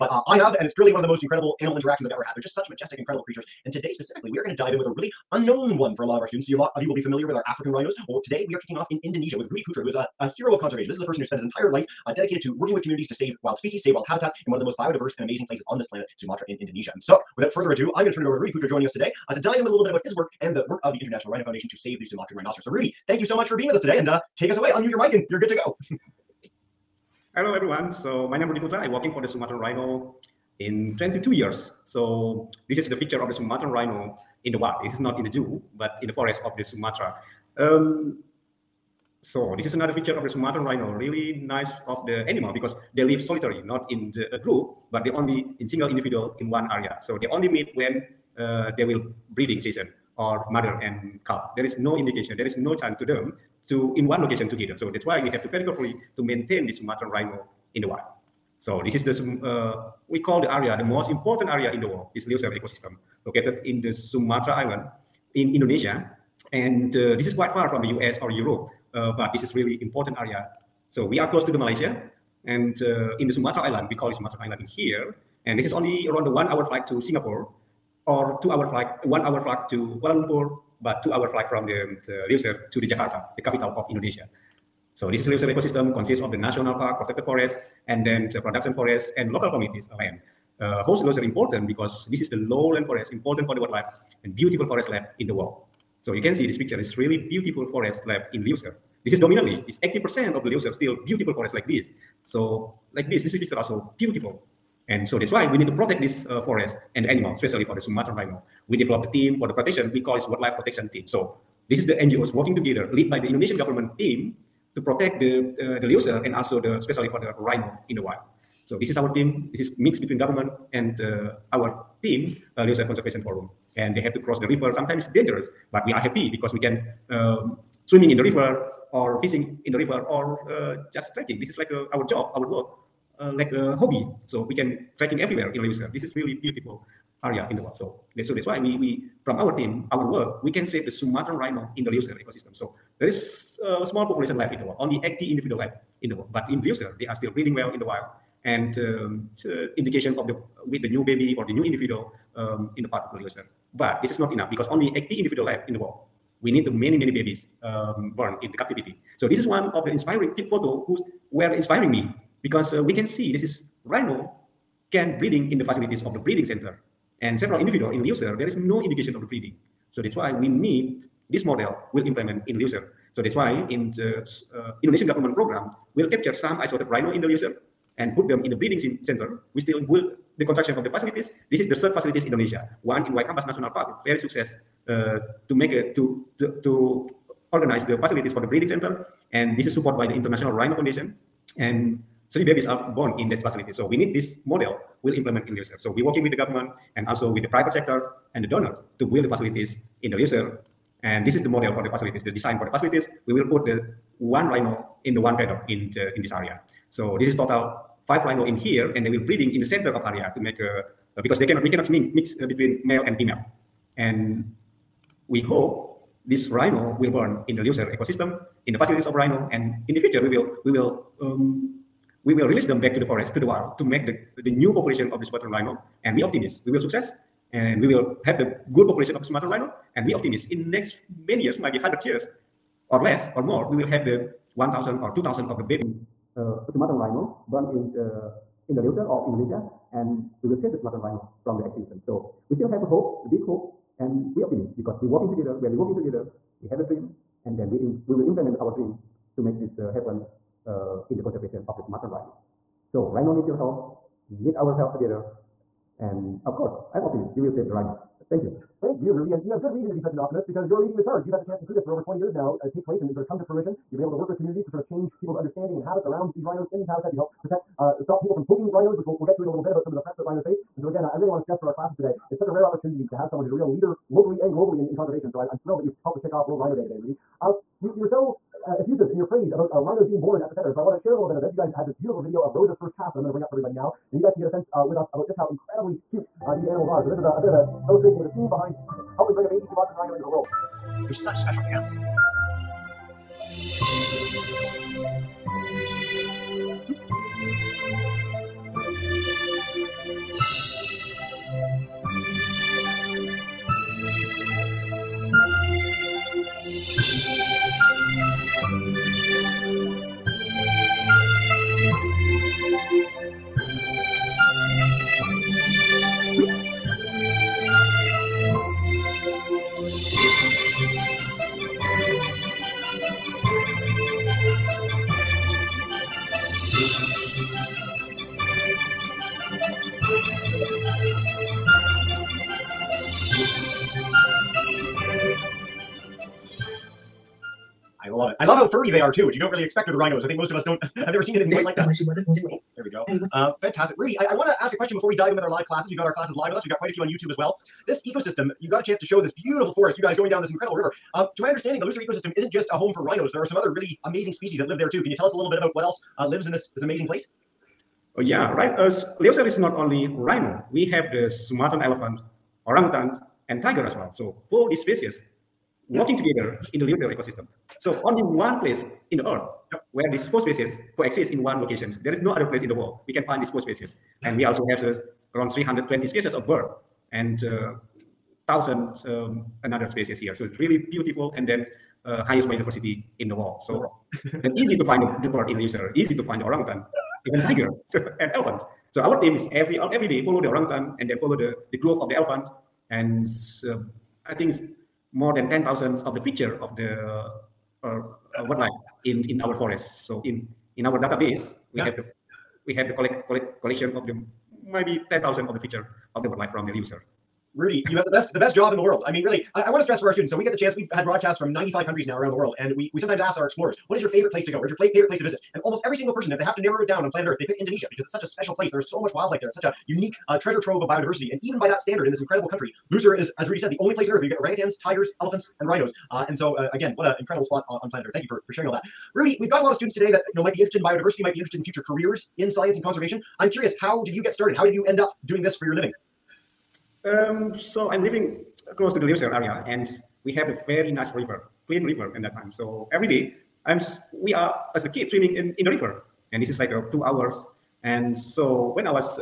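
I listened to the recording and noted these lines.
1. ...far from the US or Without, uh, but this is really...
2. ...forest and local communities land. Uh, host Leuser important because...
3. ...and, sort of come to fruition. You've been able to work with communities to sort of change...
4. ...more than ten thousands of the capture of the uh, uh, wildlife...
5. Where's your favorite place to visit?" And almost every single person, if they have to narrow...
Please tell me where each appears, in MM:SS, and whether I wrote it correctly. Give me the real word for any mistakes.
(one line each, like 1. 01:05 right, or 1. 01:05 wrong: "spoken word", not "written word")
1. 01:07 wrong: "Europe", not "Without"
2. 01:28 right
3. 04:23 right
4. 06:35 wrong: "picture", not "capture"
5. 06:54 right.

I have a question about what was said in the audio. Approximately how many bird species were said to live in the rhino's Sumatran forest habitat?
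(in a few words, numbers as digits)
320.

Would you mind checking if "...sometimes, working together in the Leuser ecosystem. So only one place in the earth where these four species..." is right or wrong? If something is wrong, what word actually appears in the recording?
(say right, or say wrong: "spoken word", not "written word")
wrong: "species", not "sometimes".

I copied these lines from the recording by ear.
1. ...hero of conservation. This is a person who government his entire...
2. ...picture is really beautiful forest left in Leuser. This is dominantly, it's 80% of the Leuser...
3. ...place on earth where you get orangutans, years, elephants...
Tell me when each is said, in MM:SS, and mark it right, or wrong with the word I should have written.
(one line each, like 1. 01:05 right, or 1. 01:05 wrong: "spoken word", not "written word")
1. 00:10 wrong: "spent", not "government"
2. 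01:36 right
3. 07:03 wrong: "tigers", not "years".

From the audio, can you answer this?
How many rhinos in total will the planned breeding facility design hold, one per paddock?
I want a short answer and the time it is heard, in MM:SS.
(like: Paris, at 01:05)
5, at 03:28.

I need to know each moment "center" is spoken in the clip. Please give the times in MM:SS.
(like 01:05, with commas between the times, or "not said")
02:46, 02:59, 03:08, 03:29, 04:40.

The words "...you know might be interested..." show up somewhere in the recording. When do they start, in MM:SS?
07:10.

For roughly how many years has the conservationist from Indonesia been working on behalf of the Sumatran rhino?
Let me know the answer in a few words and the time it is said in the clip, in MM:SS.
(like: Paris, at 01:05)
22 years, at 00:30.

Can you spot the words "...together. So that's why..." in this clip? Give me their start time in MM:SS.
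00:54.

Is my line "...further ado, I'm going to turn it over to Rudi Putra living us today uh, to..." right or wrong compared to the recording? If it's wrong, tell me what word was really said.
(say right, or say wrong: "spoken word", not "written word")
wrong: "joining", not "living".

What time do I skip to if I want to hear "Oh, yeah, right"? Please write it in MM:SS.
05:58.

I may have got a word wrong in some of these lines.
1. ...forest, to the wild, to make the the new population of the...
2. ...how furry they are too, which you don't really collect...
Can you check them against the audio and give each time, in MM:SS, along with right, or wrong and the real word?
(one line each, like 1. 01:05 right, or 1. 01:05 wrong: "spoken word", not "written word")
1. 03:43 right
2. 05:38 wrong: "expect", not "collect".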